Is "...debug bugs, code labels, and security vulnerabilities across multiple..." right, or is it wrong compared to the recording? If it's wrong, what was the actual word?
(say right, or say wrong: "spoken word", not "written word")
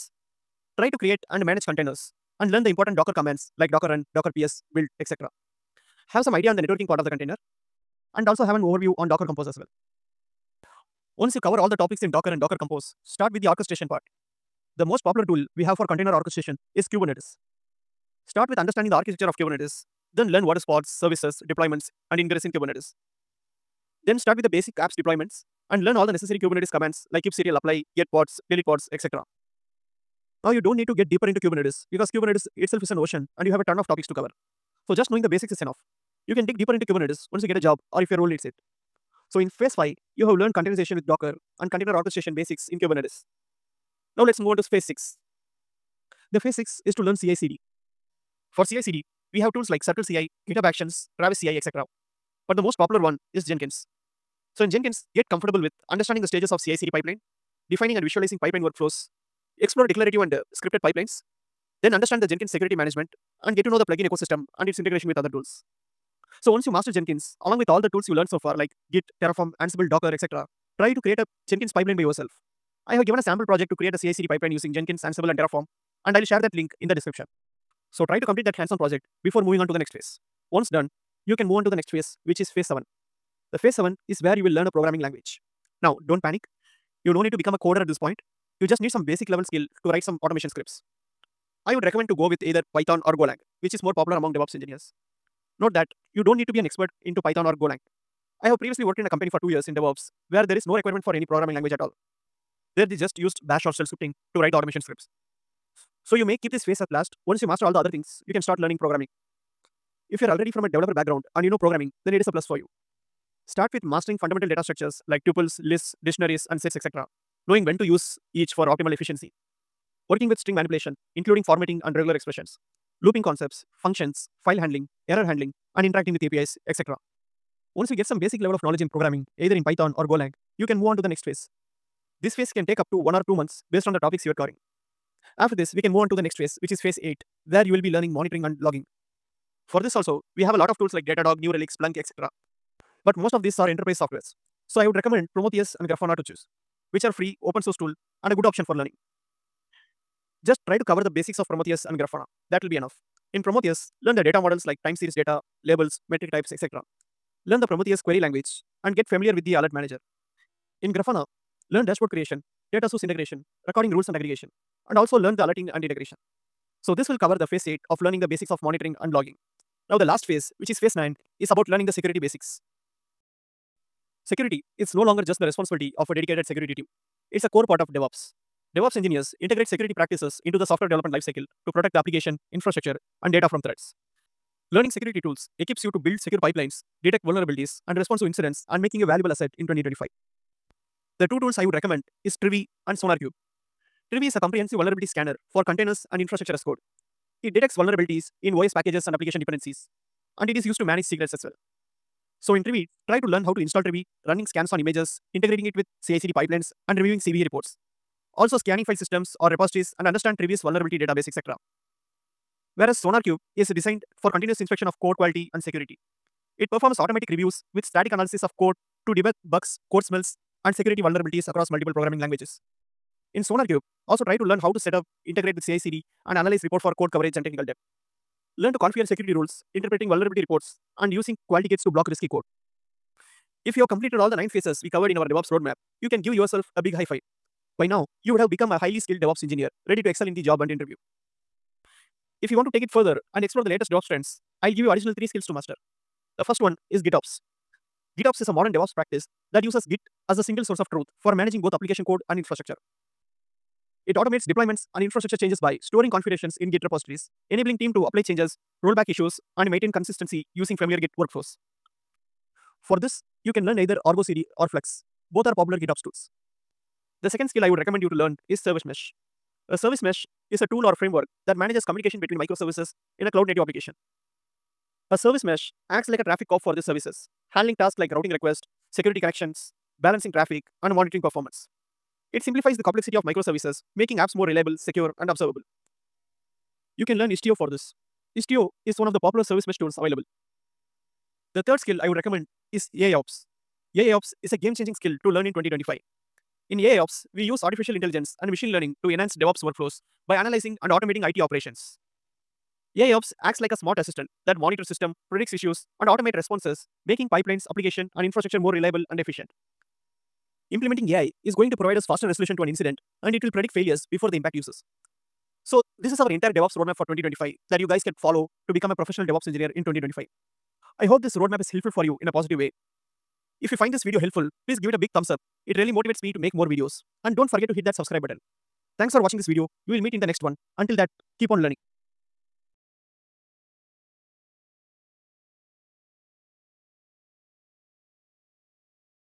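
wrong: "smells", not "labels".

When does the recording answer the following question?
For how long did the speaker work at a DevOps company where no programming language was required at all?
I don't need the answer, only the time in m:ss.
1:39.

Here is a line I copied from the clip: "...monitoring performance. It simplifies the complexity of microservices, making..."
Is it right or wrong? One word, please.
right.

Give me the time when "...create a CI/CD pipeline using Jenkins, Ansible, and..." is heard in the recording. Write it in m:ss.
1:13.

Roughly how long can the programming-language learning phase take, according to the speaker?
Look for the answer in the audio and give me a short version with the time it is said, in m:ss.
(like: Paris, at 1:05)
1 or 2 months, at 2:12.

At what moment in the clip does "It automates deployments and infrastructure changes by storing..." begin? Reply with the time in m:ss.
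4:14.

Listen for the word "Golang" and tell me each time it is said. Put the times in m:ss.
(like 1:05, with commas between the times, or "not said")
1:33, 1:37, 2:10.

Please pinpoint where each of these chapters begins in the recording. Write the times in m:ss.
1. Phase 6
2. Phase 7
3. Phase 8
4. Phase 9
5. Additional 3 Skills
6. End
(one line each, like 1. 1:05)
1. 0:45
2. 1:24
3. 2:15
4. 2:52
5. 4:03
6. 5:16.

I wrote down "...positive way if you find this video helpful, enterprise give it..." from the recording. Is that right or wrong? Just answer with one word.
wrong.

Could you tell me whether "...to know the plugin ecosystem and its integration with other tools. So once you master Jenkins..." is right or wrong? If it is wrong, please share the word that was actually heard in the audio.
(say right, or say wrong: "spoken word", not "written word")
right.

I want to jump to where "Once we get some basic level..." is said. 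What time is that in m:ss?
2:07.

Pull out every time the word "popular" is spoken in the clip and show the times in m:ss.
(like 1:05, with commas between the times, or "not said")
0:15, 0:52, 1:33, 4:25, 4:49.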